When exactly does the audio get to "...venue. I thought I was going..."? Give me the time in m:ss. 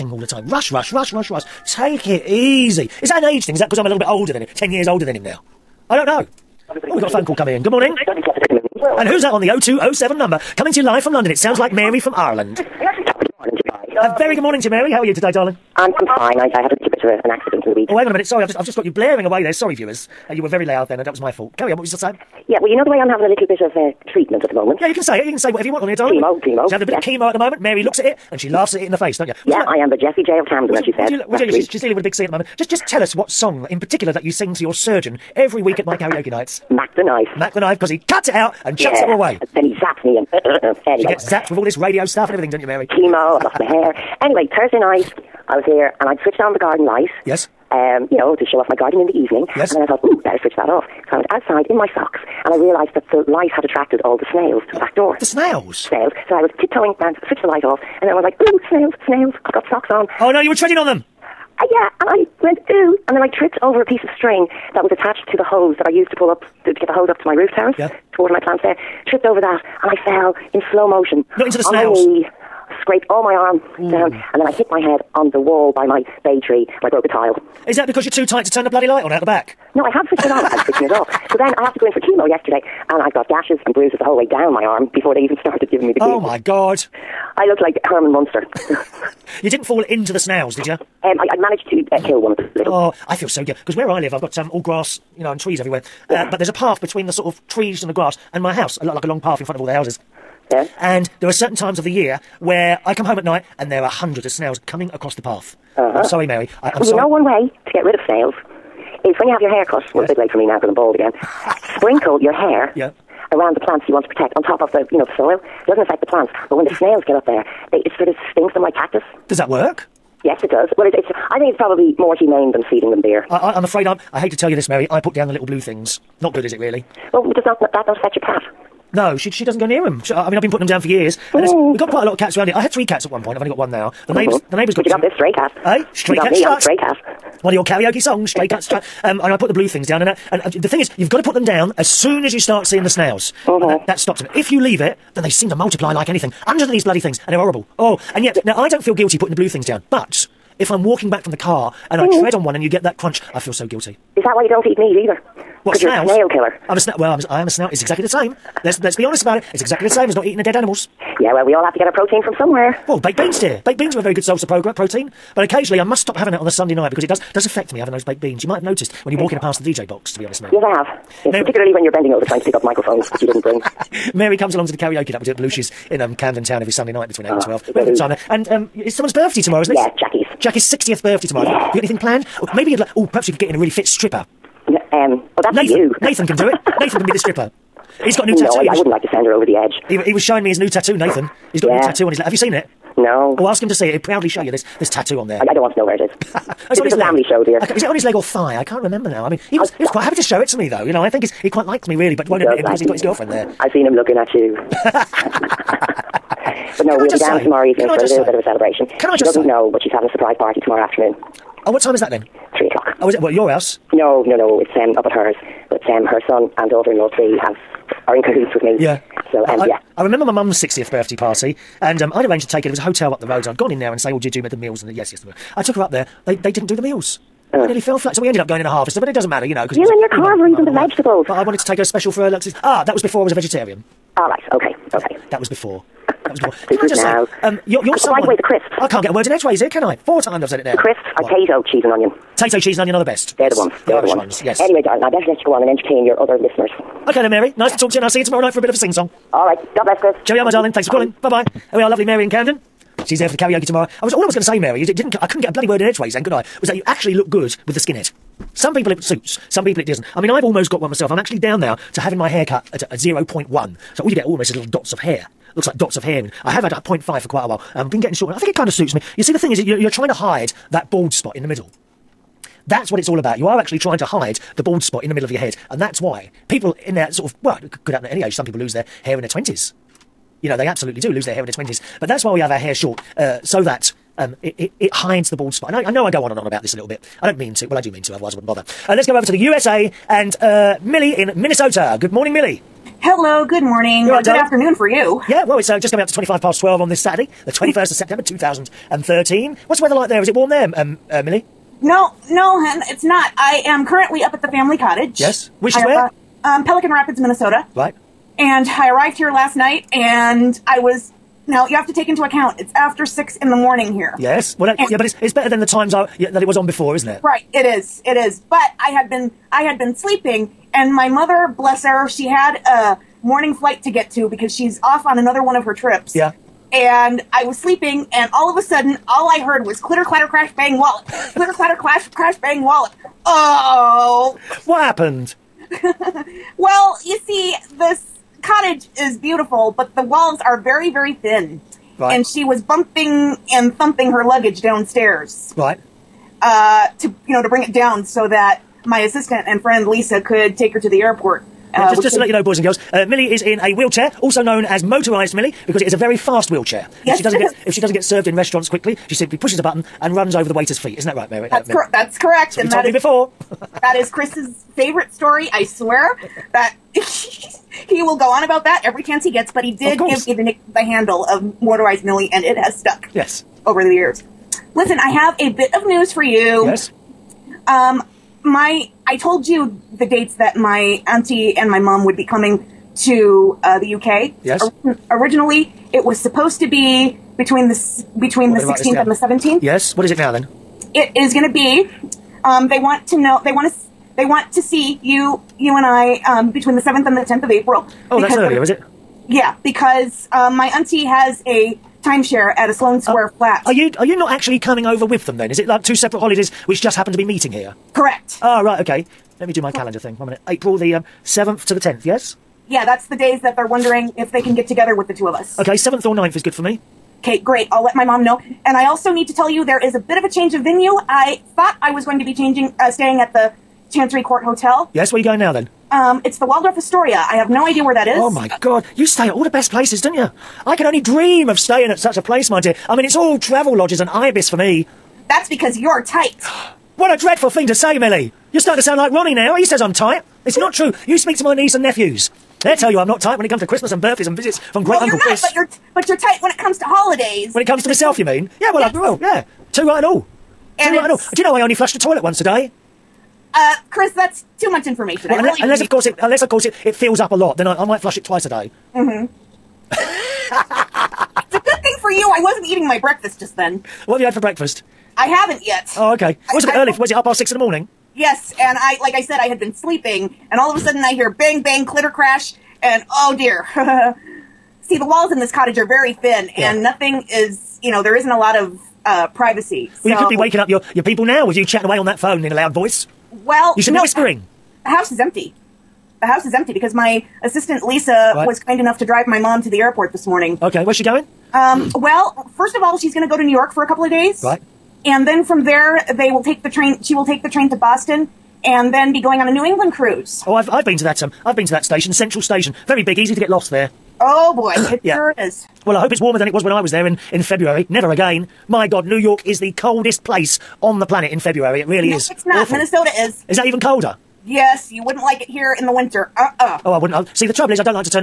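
7:00.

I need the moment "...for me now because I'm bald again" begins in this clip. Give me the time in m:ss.
1:50.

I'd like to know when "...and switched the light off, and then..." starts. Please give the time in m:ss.
0:56.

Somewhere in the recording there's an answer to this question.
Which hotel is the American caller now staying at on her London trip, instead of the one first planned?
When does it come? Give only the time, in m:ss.
7:06.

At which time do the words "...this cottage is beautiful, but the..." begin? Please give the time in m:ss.
5:37.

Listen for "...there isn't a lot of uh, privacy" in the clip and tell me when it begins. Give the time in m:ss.
7:58.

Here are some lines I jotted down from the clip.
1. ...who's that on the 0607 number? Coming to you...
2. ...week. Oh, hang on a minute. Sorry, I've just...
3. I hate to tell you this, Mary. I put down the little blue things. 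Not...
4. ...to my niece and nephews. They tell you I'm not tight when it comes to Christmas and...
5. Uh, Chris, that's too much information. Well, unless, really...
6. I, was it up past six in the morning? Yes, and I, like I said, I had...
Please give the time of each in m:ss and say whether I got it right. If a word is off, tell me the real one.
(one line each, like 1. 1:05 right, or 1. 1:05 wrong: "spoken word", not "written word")
1. 0:09 wrong: "0207", not "0607"
2. 0:17 right
3. 2:04 right
4. 7:21 right
5. 7:33 right
6. 7:46 right.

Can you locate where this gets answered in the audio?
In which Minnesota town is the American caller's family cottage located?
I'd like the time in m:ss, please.
5:06.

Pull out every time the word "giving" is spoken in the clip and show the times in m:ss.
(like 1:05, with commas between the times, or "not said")
1:25.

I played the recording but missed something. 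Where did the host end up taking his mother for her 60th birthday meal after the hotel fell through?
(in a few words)
A Harvester.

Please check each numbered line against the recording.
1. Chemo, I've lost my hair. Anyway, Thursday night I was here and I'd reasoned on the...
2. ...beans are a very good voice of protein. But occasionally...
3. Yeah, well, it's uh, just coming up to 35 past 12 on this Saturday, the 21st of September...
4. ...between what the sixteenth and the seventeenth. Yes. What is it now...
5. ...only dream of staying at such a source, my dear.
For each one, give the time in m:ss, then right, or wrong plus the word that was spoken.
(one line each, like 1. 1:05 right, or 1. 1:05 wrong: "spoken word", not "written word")
1. 0:42 wrong: "switched", not "reasoned"
2. 2:43 wrong: "source", not "voice"
3. 4:55 wrong: "25", not "35"
4. 6:28 right
5. 7:10 wrong: "place", not "source".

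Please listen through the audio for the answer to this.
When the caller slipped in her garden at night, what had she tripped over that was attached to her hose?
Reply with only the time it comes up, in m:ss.
1:03.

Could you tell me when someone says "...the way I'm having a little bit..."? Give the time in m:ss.
0:22.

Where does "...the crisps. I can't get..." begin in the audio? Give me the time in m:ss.
3:58.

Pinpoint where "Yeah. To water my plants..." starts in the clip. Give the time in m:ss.
1:07.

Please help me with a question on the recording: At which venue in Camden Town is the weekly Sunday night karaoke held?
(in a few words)
Belushi's.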